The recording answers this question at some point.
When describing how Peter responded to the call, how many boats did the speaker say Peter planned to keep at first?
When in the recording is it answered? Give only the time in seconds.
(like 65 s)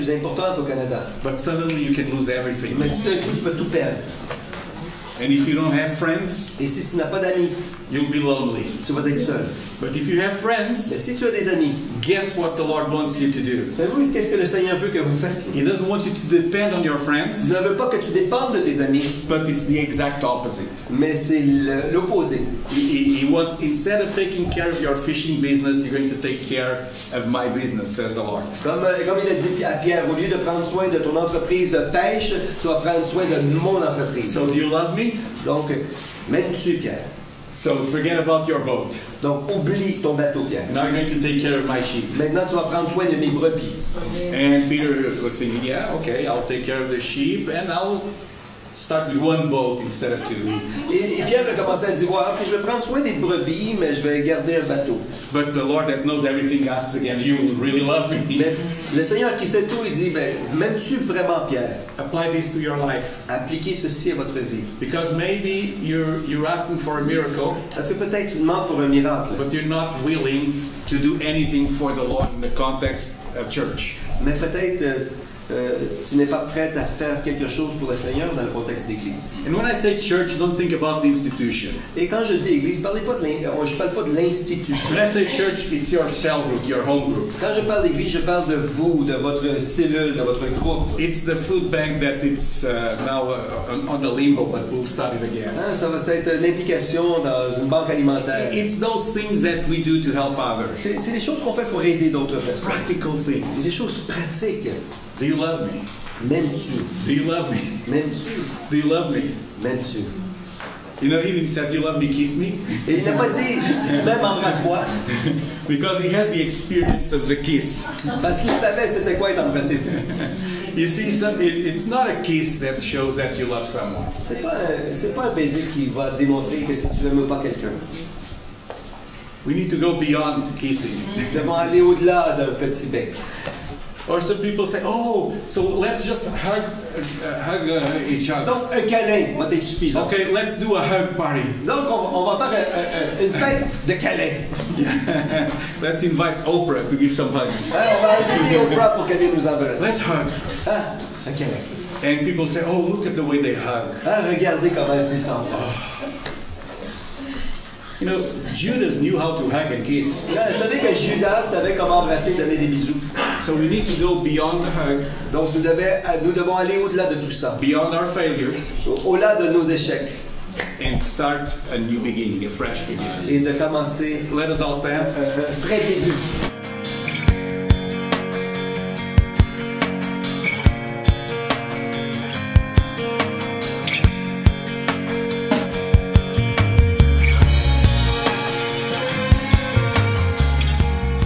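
49 s.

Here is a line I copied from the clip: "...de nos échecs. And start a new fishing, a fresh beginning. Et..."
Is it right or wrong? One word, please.
wrong.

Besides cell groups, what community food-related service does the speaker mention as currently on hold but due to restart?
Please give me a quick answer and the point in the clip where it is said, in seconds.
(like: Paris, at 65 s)
food bank, at 91 s.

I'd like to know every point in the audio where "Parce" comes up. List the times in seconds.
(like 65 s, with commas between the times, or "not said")
67 s, 118 s.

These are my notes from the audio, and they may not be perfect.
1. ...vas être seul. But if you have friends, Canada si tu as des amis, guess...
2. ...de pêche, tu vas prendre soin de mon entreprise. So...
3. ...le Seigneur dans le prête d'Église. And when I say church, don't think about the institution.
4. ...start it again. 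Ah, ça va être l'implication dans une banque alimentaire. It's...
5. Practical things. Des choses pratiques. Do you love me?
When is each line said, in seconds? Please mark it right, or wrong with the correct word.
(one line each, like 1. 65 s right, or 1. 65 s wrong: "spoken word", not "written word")
1. 8 s wrong: "Mais", not "Canada"
2. 31 s right
3. 77 s wrong: "contexte", not "prête"
4. 94 s right
5. 102 s right.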